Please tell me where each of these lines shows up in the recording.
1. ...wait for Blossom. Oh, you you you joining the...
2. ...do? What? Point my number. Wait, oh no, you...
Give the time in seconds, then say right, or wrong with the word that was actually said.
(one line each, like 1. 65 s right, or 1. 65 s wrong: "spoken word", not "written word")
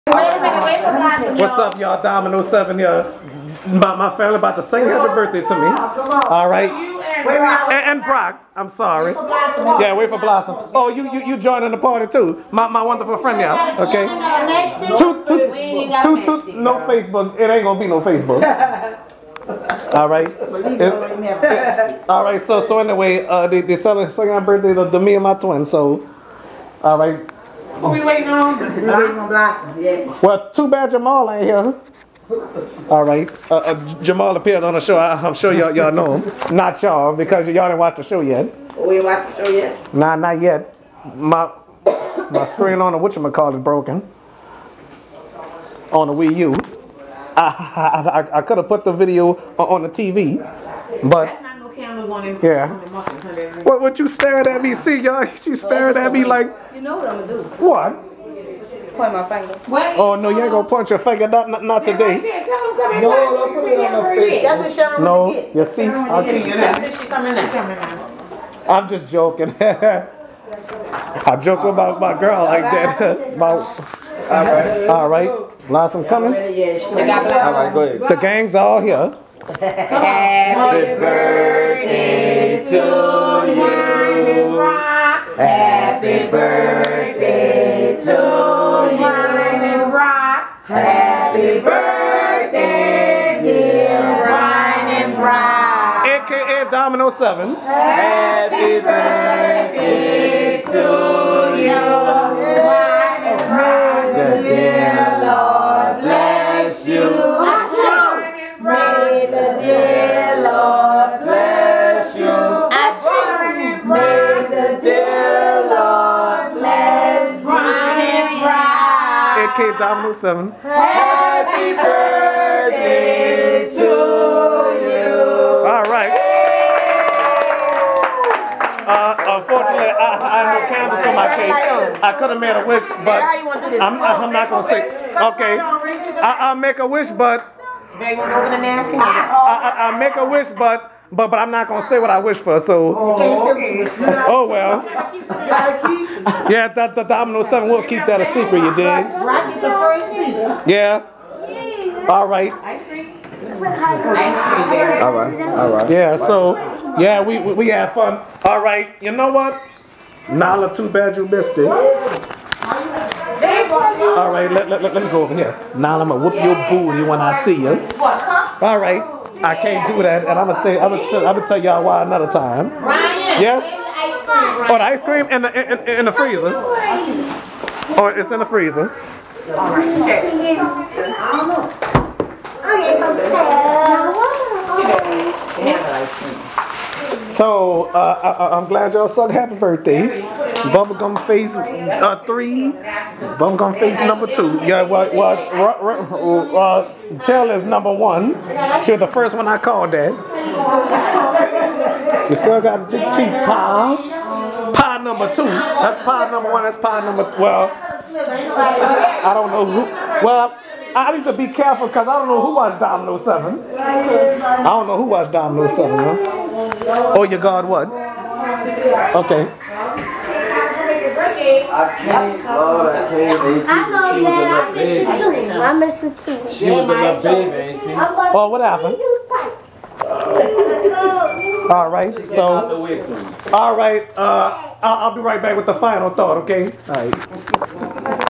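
1. 9 s right
2. 57 s wrong: "finger", not "number".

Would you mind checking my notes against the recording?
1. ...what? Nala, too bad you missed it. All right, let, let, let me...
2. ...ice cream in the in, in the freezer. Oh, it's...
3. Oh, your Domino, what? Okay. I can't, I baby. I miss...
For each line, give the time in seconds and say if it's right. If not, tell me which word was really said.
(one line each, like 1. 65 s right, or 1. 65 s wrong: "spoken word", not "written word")
1. 159 s right
2. 174 s right
3. 217 s wrong: "God", not "Domino".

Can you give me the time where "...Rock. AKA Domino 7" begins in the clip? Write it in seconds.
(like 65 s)
95 s.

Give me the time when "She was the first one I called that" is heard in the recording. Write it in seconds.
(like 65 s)
198 s.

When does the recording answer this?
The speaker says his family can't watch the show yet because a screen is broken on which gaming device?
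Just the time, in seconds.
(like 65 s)
46 s.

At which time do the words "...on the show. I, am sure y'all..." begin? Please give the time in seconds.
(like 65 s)
34 s.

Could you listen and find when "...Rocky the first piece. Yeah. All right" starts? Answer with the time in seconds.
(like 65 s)
148 s.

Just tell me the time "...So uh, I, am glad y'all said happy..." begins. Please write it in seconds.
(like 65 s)
187 s.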